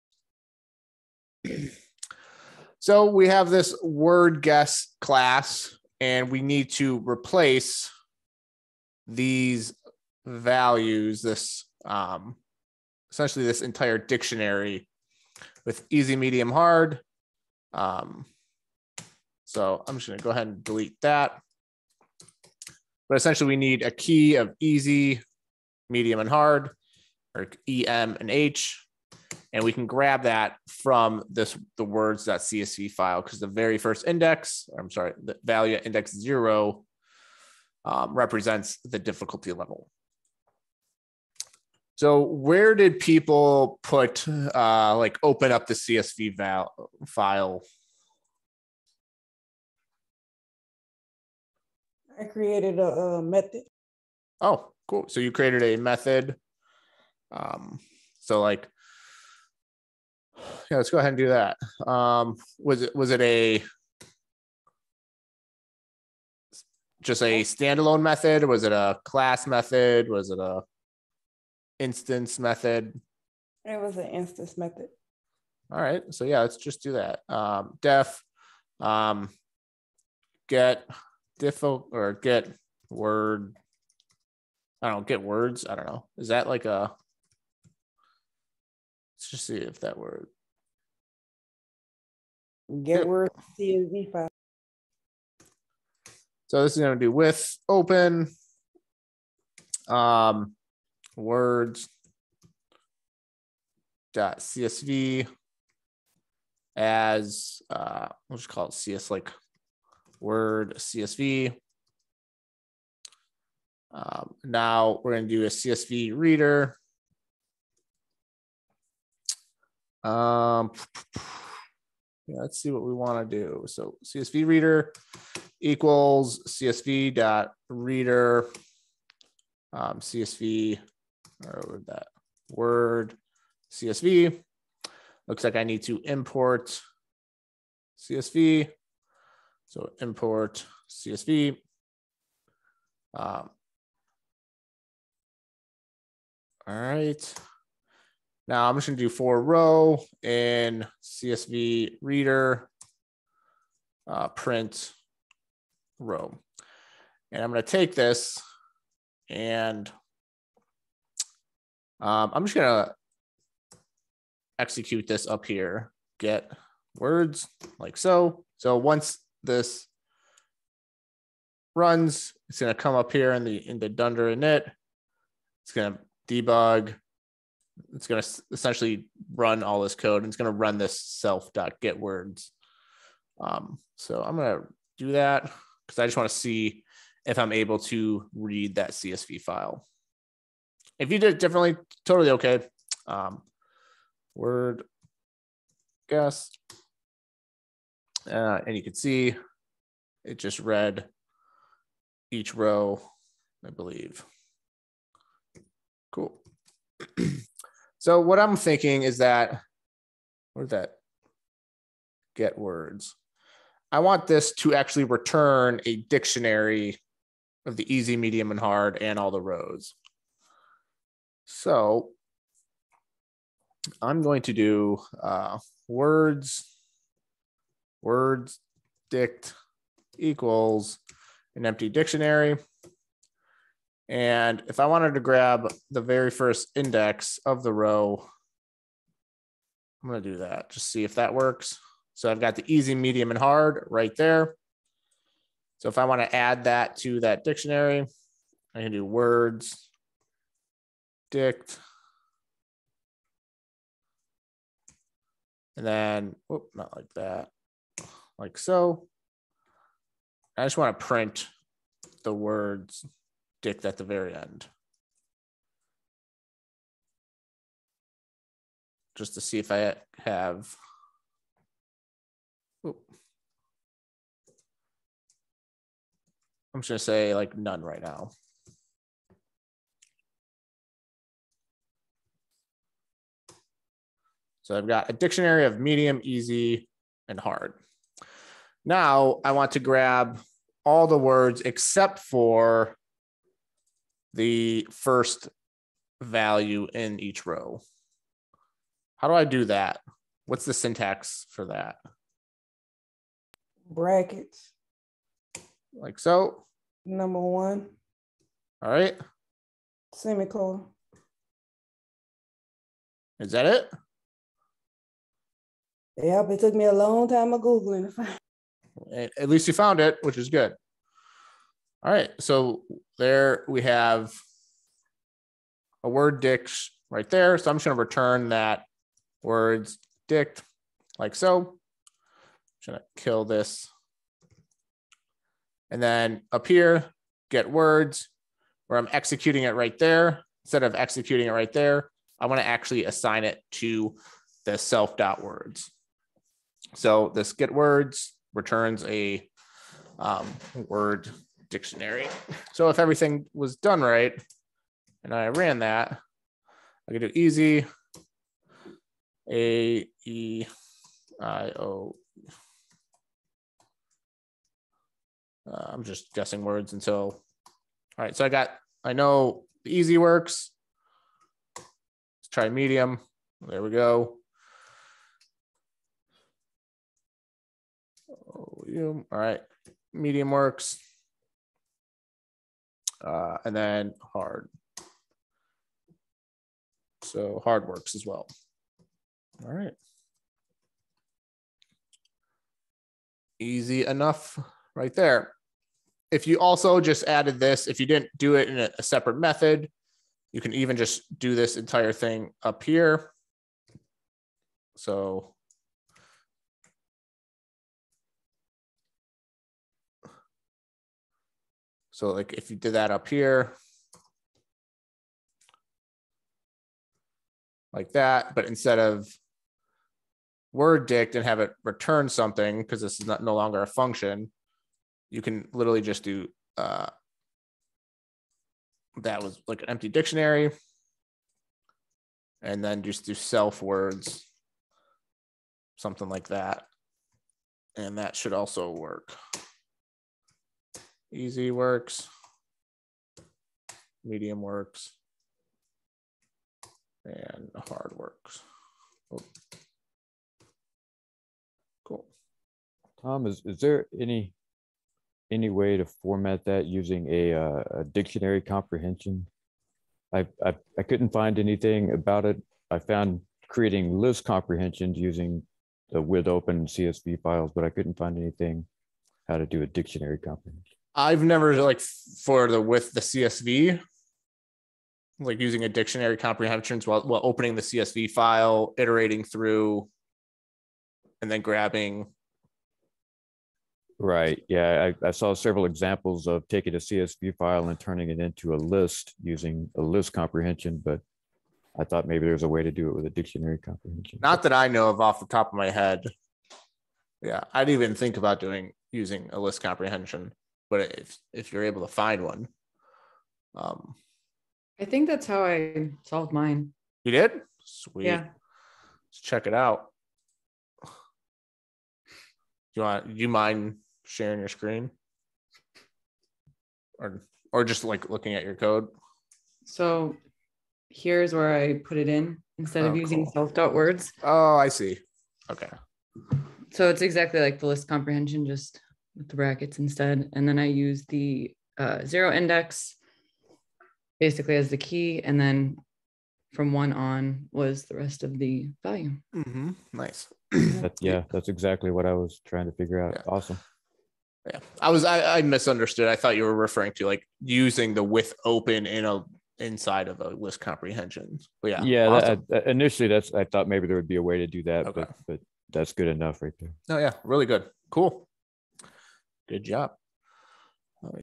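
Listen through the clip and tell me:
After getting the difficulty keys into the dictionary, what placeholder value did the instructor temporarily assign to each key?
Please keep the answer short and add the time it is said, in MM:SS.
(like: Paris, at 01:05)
None, at 04:37.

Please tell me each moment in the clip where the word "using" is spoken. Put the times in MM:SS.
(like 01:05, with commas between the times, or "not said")
07:36, 07:45, 07:55, 08:09, 08:19, 08:43, 09:07.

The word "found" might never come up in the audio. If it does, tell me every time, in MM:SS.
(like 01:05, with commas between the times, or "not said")
05:19, 07:42.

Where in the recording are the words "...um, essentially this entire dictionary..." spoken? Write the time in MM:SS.
00:11.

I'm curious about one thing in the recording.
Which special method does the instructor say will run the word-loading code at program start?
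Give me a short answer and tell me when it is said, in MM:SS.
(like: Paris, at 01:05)
dunder init, at 02:53.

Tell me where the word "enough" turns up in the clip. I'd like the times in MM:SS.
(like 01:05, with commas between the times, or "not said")
06:34, 09:16.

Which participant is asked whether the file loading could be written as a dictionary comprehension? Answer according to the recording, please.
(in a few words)
Tom.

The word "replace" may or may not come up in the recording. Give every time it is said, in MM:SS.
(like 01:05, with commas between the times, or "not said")
00:07.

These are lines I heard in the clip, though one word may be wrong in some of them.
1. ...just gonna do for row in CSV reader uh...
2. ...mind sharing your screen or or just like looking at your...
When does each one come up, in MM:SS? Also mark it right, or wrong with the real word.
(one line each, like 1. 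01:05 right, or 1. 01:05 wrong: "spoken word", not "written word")
1. 02:28 right
2. 08:33 right.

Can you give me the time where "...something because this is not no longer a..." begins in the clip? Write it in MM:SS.
07:02.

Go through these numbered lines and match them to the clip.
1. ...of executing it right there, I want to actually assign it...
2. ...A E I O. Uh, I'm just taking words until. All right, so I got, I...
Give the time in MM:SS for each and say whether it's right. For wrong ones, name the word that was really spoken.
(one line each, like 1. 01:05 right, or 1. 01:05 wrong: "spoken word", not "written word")
1. 05:40 right
2. 05:59 wrong: "guessing", not "taking".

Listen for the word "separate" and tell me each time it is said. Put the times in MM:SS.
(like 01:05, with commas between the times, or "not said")
06:39.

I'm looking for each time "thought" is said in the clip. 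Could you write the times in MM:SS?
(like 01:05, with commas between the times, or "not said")
08:12, 09:06, 09:13.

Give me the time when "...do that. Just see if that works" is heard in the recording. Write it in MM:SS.
04:00.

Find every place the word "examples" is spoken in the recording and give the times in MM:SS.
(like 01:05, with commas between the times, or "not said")
08:05.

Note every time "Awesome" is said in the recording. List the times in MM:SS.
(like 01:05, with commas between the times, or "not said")
09:03, 09:12.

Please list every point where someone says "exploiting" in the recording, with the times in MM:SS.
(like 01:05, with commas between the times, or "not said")
not said.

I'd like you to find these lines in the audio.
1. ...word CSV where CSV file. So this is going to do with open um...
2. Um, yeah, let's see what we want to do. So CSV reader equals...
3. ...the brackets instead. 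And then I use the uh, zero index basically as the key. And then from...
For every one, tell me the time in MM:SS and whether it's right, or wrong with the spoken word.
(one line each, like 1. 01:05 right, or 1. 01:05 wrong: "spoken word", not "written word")
1. 01:29 wrong: "Get", not "CSV"
2. 02:00 right
3. 08:49 right.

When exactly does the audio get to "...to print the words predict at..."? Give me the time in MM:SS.
04:20.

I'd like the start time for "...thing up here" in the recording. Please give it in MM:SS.
06:42.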